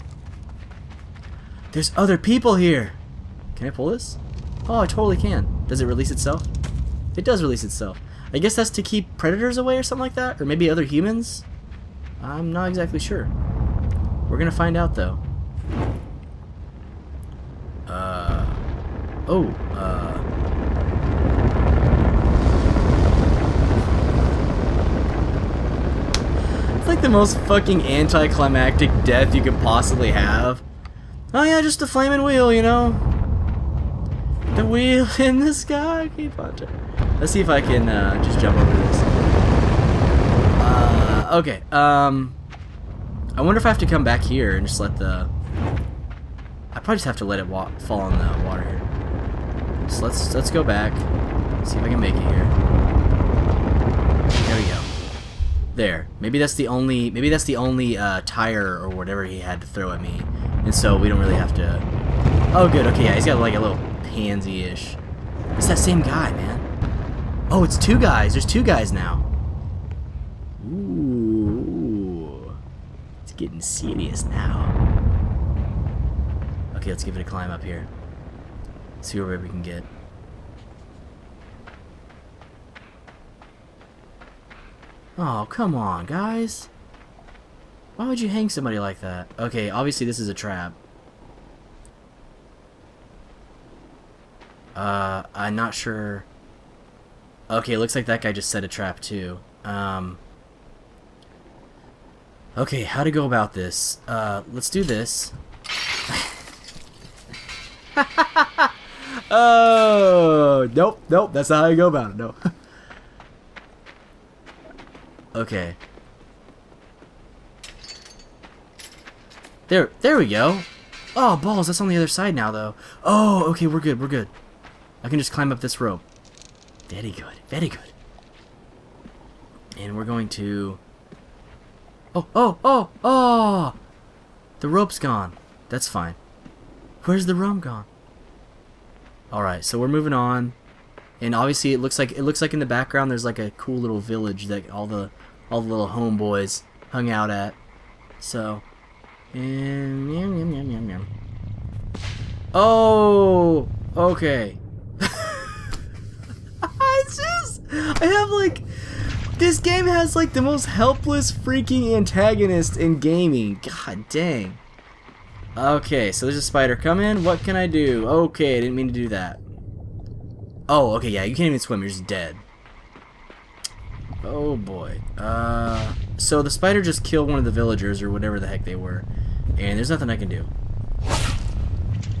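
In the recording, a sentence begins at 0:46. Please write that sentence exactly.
I probably just have to let it fall in the water here.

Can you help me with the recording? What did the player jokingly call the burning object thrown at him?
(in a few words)
flaming wheel.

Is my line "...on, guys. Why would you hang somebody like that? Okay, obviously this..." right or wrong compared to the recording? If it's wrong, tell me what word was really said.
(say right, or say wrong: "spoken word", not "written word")
right.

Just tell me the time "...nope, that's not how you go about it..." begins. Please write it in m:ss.
1:51.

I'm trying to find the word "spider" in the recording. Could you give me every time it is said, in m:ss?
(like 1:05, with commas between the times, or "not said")
2:46, 2:56.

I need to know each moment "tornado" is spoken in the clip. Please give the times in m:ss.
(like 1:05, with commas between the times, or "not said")
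not said.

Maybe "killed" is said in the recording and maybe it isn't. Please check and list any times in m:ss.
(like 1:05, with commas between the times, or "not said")
2:57.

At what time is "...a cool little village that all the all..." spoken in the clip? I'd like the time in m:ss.
2:23.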